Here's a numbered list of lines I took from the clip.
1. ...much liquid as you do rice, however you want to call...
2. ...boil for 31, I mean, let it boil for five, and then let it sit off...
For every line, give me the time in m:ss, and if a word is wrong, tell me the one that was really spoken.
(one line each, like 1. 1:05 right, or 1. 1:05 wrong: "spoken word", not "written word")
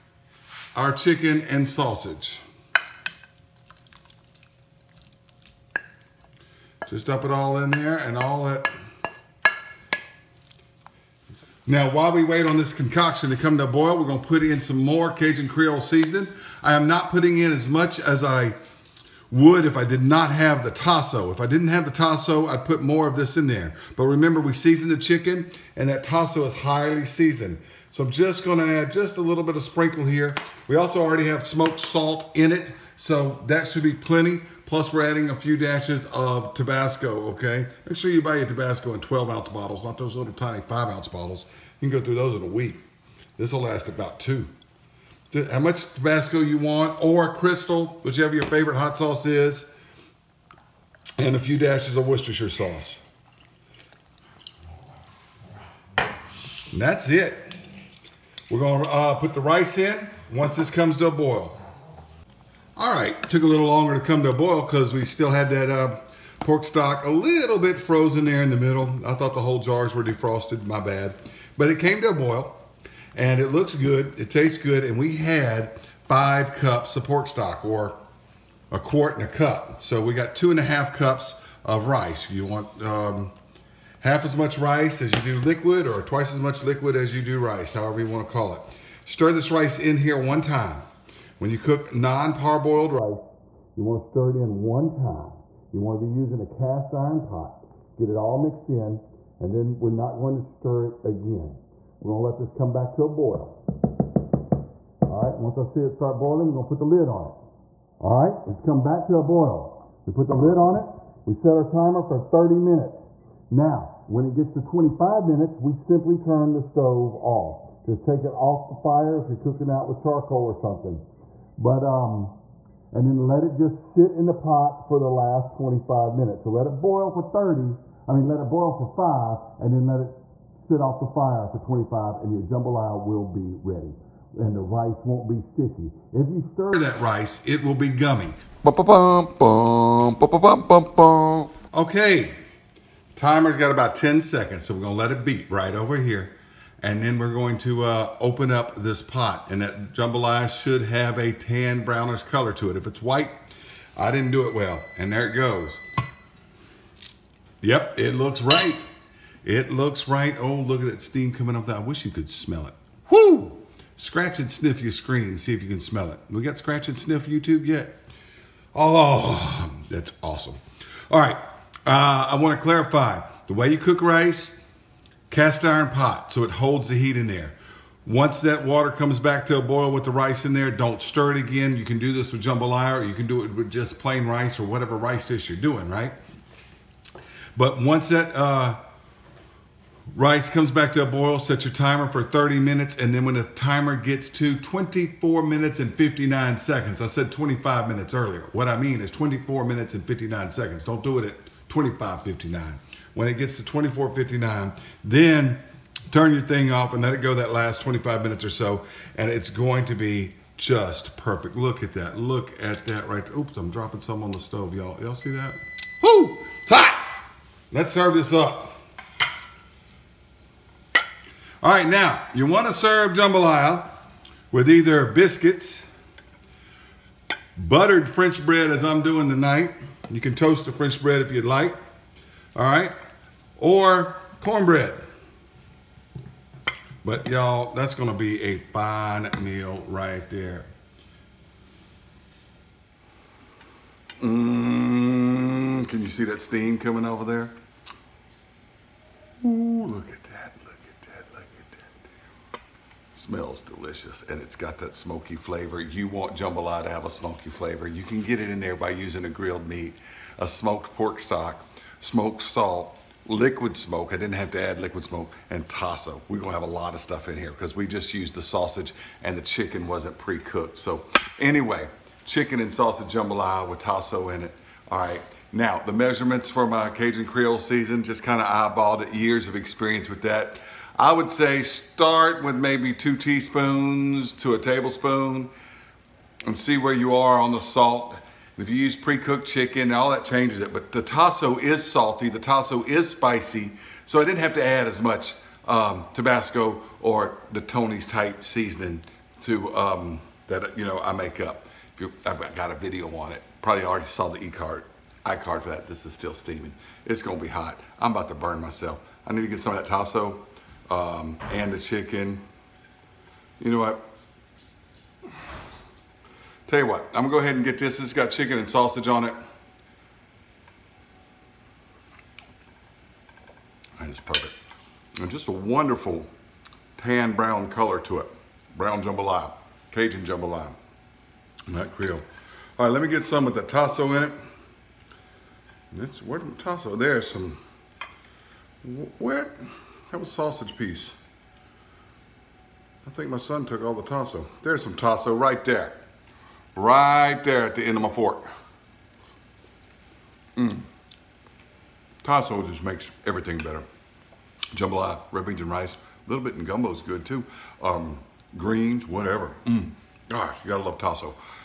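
1. 1:26 right
2. 2:06 wrong: "30", not "31".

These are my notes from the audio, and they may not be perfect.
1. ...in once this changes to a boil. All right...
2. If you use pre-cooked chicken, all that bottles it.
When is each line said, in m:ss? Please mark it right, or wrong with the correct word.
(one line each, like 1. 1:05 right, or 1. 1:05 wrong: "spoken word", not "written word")
1. 0:59 wrong: "comes", not "changes"
2. 4:48 wrong: "changes", not "bottles".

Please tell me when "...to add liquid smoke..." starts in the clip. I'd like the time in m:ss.
4:24.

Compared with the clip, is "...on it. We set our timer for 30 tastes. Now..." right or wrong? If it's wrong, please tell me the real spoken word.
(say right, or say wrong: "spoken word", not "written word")
wrong: "minutes", not "tastes".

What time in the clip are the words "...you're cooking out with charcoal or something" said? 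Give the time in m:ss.
1:59.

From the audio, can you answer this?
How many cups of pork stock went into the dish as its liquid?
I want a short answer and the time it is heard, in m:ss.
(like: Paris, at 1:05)
5 cups, at 1:16.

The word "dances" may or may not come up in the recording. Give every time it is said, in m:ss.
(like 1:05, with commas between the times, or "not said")
not said.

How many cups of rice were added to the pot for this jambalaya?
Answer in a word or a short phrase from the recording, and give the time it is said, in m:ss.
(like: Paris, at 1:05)
2.5 cups, at 1:20.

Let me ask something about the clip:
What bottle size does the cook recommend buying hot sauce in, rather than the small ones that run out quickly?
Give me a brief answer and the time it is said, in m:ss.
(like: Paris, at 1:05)
12 ounce, at 0:38.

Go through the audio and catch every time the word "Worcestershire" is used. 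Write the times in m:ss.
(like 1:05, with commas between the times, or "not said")
0:52.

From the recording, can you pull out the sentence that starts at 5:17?
It's got chicken and sausage on it.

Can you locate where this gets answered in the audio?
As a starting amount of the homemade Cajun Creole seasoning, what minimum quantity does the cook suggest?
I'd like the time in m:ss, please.
4:42.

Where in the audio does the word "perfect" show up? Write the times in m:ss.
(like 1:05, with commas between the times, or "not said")
3:31, 5:24.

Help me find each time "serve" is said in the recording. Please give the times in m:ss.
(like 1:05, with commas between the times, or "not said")
3:37, 3:42.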